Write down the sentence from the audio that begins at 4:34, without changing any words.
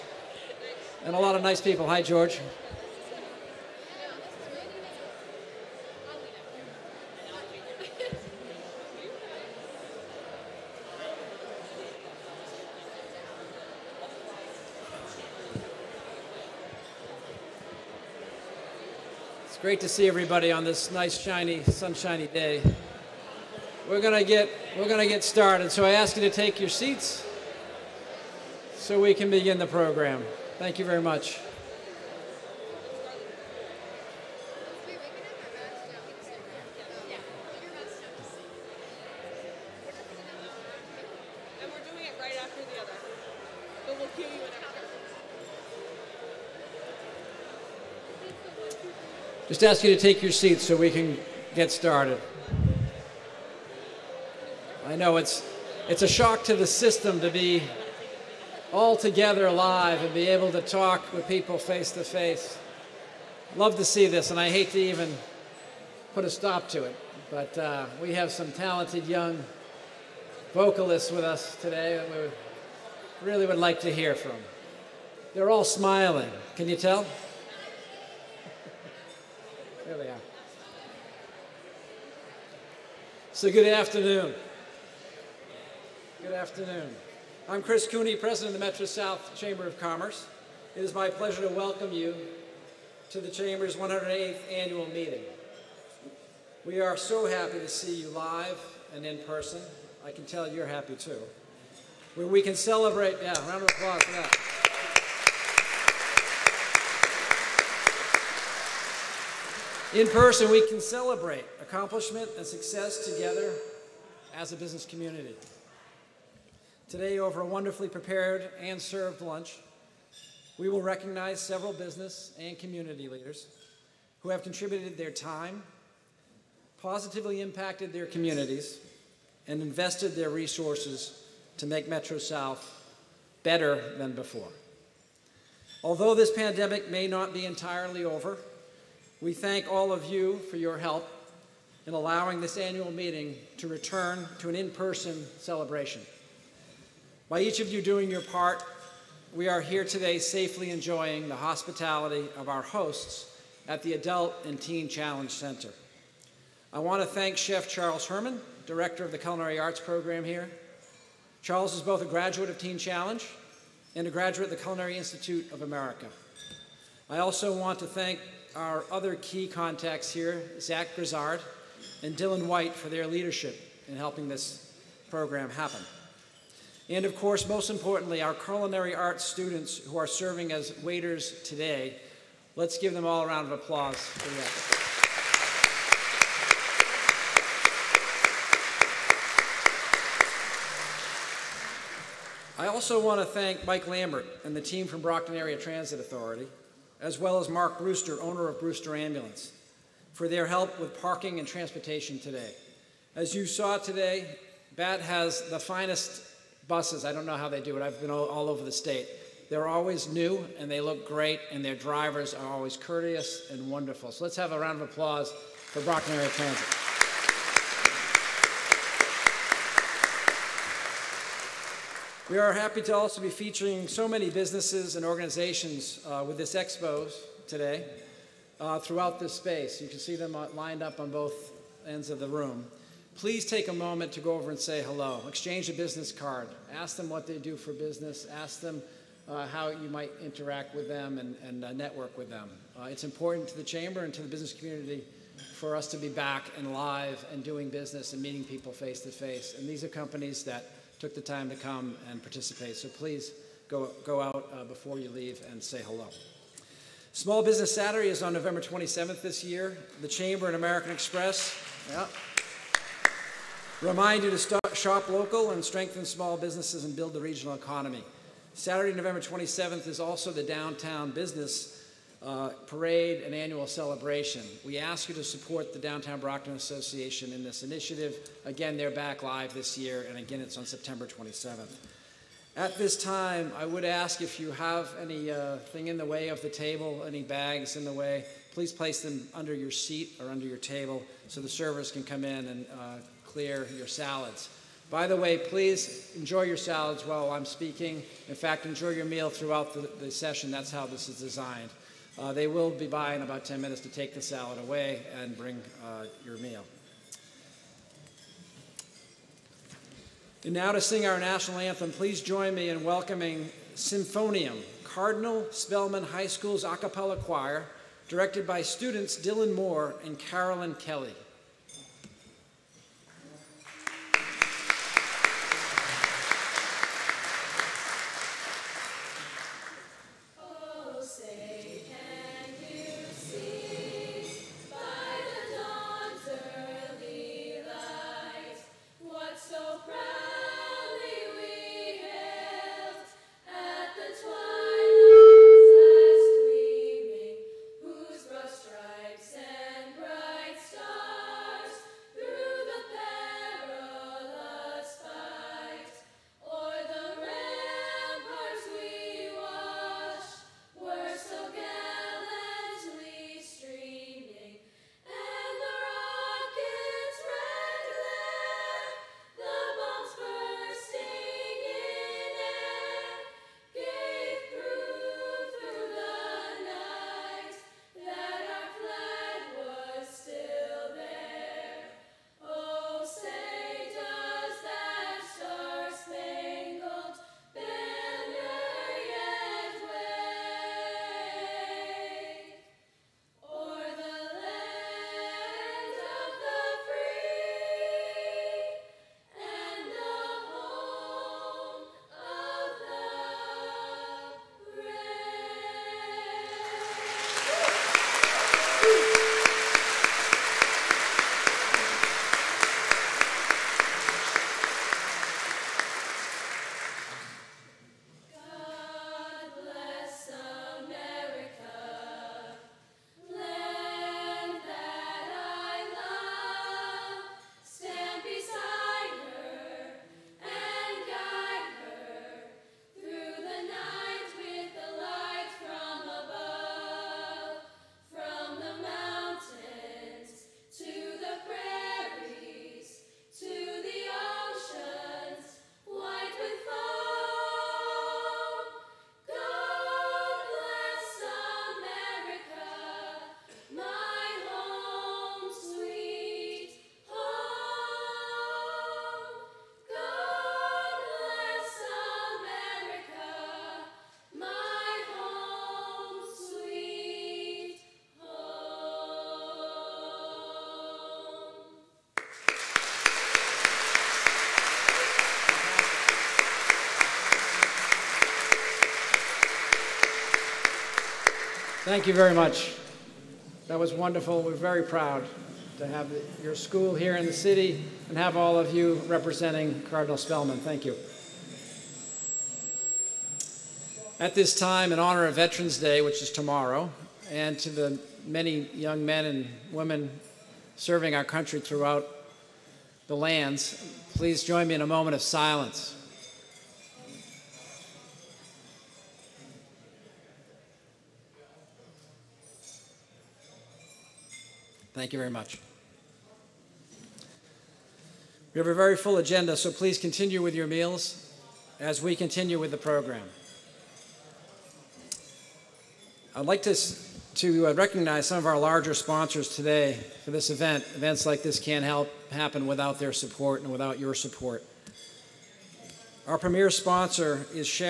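We ask you to support the Downtown Brockton Association in this initiative.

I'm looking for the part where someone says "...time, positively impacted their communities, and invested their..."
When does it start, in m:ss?
2:05.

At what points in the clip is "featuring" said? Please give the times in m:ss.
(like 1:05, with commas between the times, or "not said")
3:43.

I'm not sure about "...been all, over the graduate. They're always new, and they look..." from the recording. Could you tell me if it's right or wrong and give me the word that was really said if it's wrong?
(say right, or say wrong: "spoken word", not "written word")
wrong: "state", not "graduate".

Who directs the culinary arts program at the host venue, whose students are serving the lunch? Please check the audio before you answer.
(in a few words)
Charles Herman.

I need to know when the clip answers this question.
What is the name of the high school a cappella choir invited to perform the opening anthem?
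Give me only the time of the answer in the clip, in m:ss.
5:13.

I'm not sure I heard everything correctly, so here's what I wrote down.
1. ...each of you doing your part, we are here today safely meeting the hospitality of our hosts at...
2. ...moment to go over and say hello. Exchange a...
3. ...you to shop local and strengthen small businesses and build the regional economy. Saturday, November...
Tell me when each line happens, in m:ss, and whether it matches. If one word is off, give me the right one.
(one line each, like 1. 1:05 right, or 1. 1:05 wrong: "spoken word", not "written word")
1. 2:27 wrong: "enjoying", not "meeting"
2. 3:53 right
3. 4:24 right.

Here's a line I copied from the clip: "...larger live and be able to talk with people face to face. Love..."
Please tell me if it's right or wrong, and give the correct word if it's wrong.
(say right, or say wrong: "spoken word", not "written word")
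wrong: "together", not "larger".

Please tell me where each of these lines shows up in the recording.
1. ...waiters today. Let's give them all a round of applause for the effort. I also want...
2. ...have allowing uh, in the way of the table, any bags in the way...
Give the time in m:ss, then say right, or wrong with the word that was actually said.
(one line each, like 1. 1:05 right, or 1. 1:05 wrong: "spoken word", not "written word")
1. 3:00 right
2. 4:44 wrong: "anything", not "allowing".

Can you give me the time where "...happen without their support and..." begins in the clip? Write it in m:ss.
8:52.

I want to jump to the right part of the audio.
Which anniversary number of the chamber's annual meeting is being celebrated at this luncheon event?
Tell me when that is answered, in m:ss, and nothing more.
1:33.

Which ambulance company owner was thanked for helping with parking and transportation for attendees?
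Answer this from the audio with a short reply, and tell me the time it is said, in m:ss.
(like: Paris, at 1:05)
Mark Brewster, at 3:17.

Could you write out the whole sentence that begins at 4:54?
By the way, please enjoy your salads while I'm speaking.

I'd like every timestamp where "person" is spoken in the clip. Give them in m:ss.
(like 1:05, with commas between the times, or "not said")
1:39, 1:50, 2:24.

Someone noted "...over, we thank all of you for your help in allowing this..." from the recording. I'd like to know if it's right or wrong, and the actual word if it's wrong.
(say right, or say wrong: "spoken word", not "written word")
right.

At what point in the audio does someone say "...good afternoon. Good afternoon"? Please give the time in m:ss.
1:23.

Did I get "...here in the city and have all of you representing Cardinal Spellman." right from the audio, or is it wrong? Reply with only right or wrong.
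right.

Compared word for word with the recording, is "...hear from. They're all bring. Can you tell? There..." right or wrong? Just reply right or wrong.
wrong.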